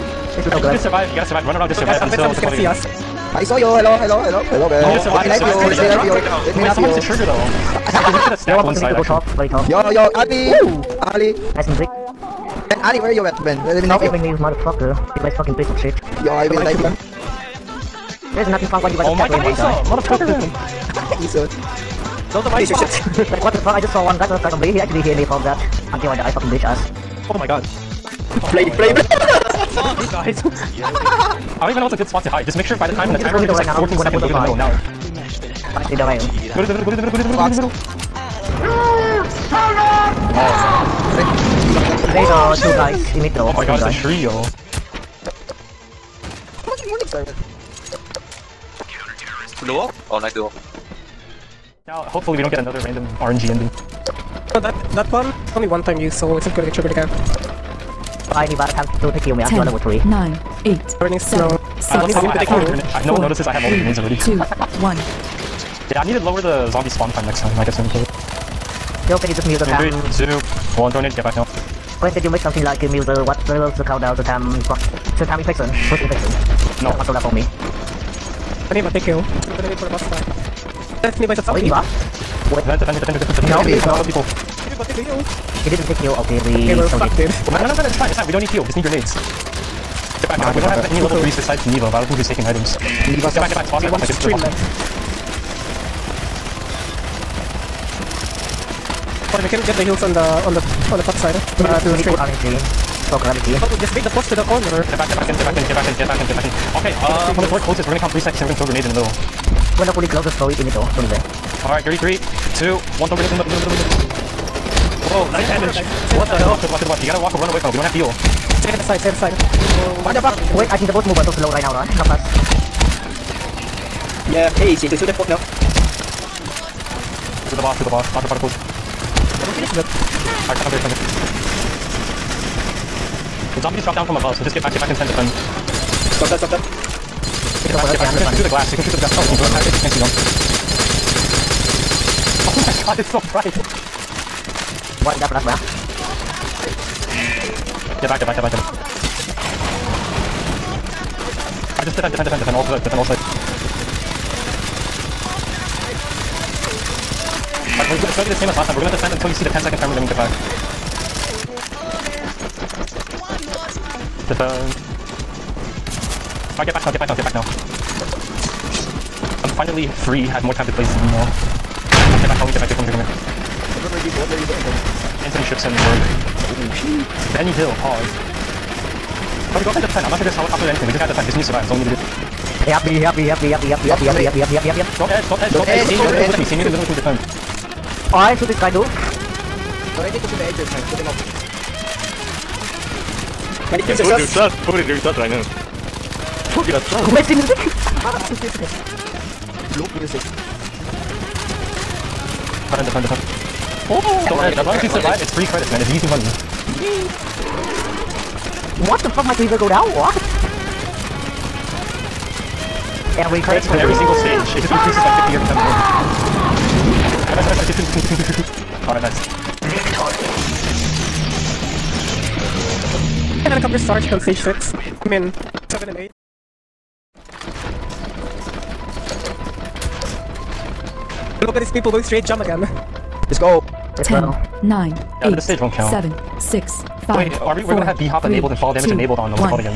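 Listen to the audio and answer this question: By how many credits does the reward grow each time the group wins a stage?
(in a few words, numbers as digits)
50.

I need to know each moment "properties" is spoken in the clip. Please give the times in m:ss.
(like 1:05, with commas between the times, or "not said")
not said.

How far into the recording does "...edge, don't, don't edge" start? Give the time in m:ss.
3:05.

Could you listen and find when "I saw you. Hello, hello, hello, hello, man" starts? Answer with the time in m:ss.
0:03.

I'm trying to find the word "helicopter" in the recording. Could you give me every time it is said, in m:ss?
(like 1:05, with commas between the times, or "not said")
3:00, 3:43.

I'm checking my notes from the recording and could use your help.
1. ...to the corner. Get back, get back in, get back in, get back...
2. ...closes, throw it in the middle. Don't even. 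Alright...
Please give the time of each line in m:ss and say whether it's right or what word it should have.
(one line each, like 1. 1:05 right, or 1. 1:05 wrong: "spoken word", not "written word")
1. 1:44 right
2. 1:50 right.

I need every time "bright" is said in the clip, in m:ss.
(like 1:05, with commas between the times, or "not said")
2:23.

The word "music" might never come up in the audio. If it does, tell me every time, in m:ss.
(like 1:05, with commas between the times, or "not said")
0:11, 3:17.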